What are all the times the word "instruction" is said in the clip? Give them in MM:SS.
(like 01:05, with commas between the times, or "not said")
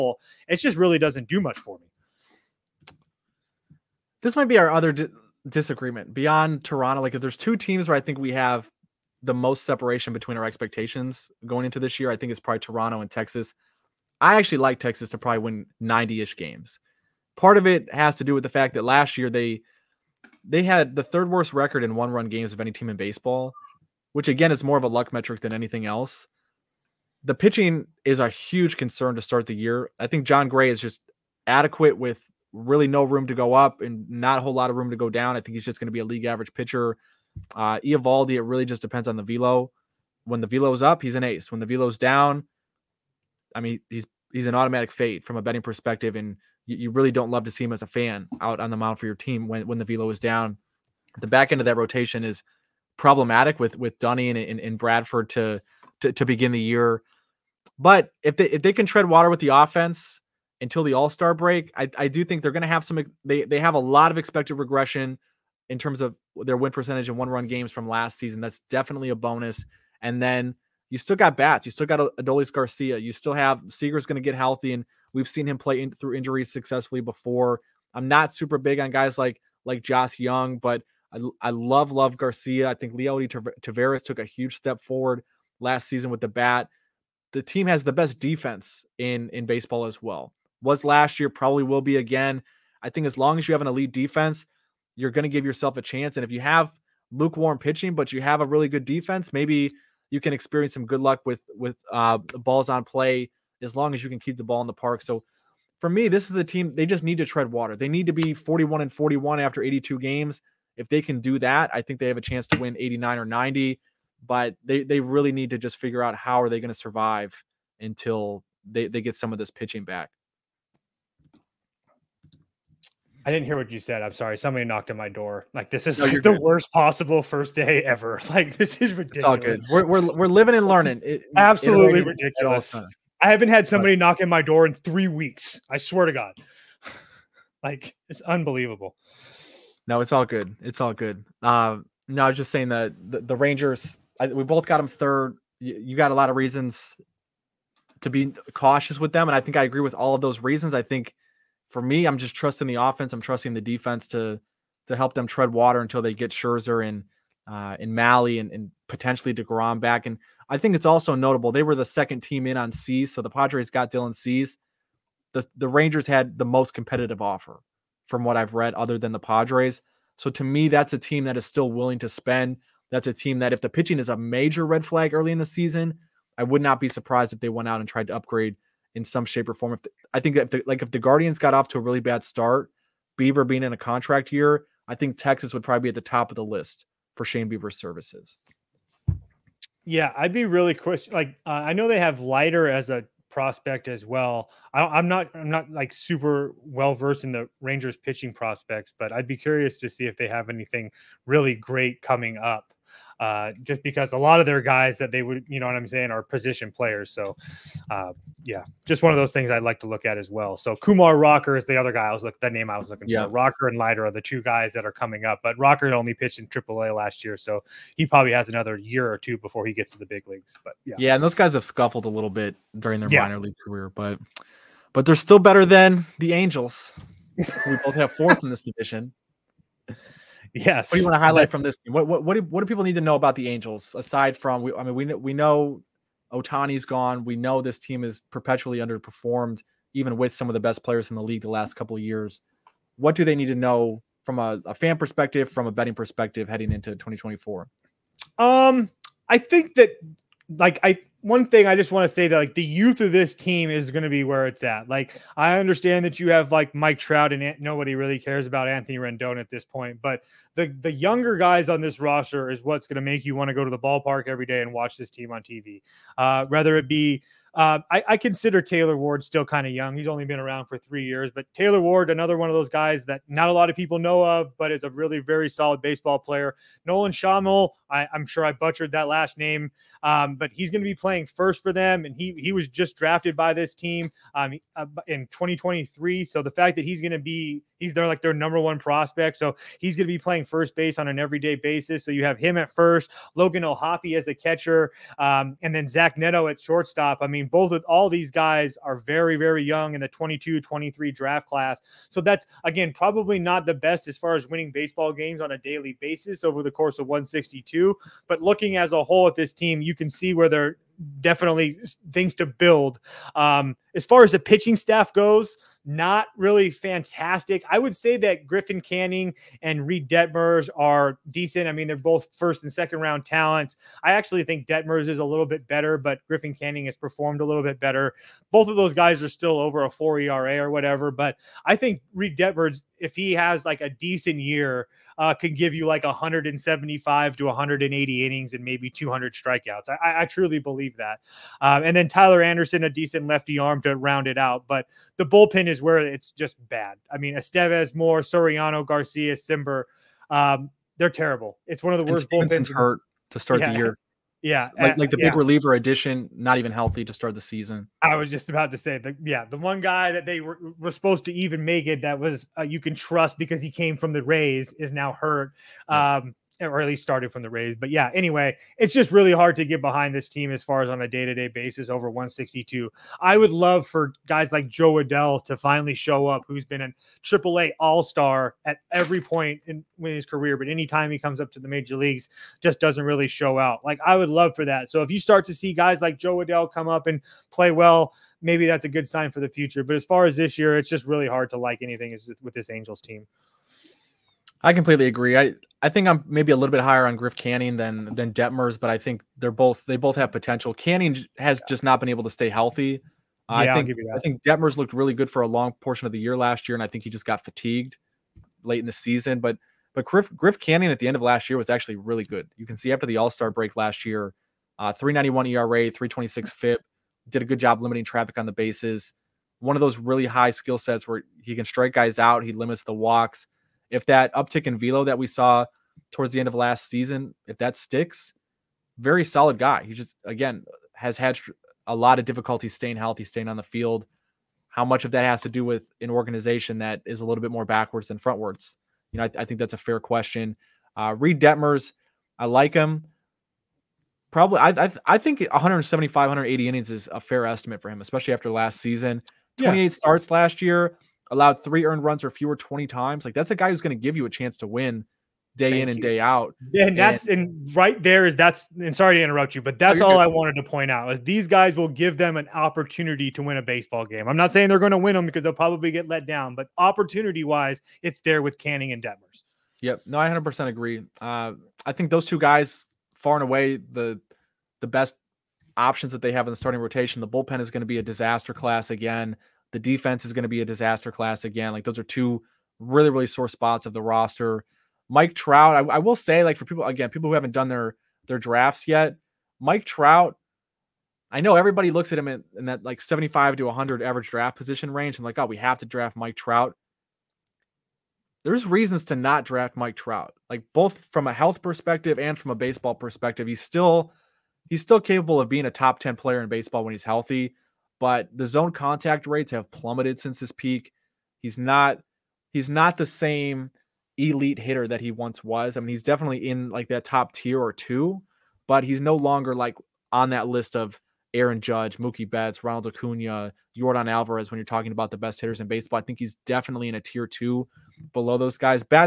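not said.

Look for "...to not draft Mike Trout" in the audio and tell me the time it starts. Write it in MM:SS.
08:19.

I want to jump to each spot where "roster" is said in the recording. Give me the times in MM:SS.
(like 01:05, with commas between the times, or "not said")
04:21, 08:04.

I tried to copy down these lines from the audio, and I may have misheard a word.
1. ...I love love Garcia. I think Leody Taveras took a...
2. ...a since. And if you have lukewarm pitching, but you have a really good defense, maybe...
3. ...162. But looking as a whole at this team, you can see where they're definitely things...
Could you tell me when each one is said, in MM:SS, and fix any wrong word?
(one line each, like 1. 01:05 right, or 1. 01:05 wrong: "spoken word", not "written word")
1. 01:21 right
2. 01:35 wrong: "chance", not "since"
3. 05:07 right.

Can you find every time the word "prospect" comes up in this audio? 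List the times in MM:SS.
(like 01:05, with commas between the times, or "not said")
03:13, 03:18, 04:48.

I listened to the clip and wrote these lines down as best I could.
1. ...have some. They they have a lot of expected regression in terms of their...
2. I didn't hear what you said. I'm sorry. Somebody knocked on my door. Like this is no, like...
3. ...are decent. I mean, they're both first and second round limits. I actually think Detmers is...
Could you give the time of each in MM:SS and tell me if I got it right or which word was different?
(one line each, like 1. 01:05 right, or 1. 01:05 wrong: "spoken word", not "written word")
1. 01:02 right
2. 02:03 right
3. 05:20 wrong: "talents", not "limits".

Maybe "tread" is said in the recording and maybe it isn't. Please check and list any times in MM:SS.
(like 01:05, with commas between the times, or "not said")
00:58, 01:47, 02:35.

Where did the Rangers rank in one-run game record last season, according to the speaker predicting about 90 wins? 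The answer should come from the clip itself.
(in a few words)
Third worst.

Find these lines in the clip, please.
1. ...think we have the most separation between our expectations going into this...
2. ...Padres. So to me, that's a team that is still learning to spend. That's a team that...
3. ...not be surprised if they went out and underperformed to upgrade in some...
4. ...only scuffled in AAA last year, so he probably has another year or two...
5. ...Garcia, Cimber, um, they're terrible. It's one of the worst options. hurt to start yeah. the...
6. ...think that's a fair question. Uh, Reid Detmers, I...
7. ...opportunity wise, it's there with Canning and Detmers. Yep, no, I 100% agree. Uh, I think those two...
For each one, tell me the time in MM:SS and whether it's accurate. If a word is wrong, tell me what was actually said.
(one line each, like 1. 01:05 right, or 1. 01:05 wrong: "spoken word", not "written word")
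1. 00:08 right
2. 02:49 wrong: "willing", not "learning"
3. 02:56 wrong: "tried", not "underperformed"
4. 03:35 wrong: "pitched", not "scuffled"
5. 05:48 wrong: "bullpens", not "options"
6. 07:19 right
7. 07:46 right.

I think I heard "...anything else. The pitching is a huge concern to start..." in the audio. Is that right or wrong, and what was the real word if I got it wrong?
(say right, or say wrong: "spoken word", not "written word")
right.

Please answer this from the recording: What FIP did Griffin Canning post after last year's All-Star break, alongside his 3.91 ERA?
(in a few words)
3.26.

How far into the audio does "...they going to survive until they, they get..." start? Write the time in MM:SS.
01:56.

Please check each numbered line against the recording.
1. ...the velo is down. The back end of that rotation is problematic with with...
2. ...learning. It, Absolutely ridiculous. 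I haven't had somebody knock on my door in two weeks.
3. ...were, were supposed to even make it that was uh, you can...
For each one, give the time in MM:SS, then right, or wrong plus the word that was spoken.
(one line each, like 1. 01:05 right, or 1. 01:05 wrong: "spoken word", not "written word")
1. 00:49 right
2. 02:10 wrong: "three", not "two"
3. 06:00 right.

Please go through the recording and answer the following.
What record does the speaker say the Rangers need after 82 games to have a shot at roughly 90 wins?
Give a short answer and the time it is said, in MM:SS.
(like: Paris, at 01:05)
41 and 41, at 01:48.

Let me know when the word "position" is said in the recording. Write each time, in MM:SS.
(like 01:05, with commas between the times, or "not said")
03:26, 08:14.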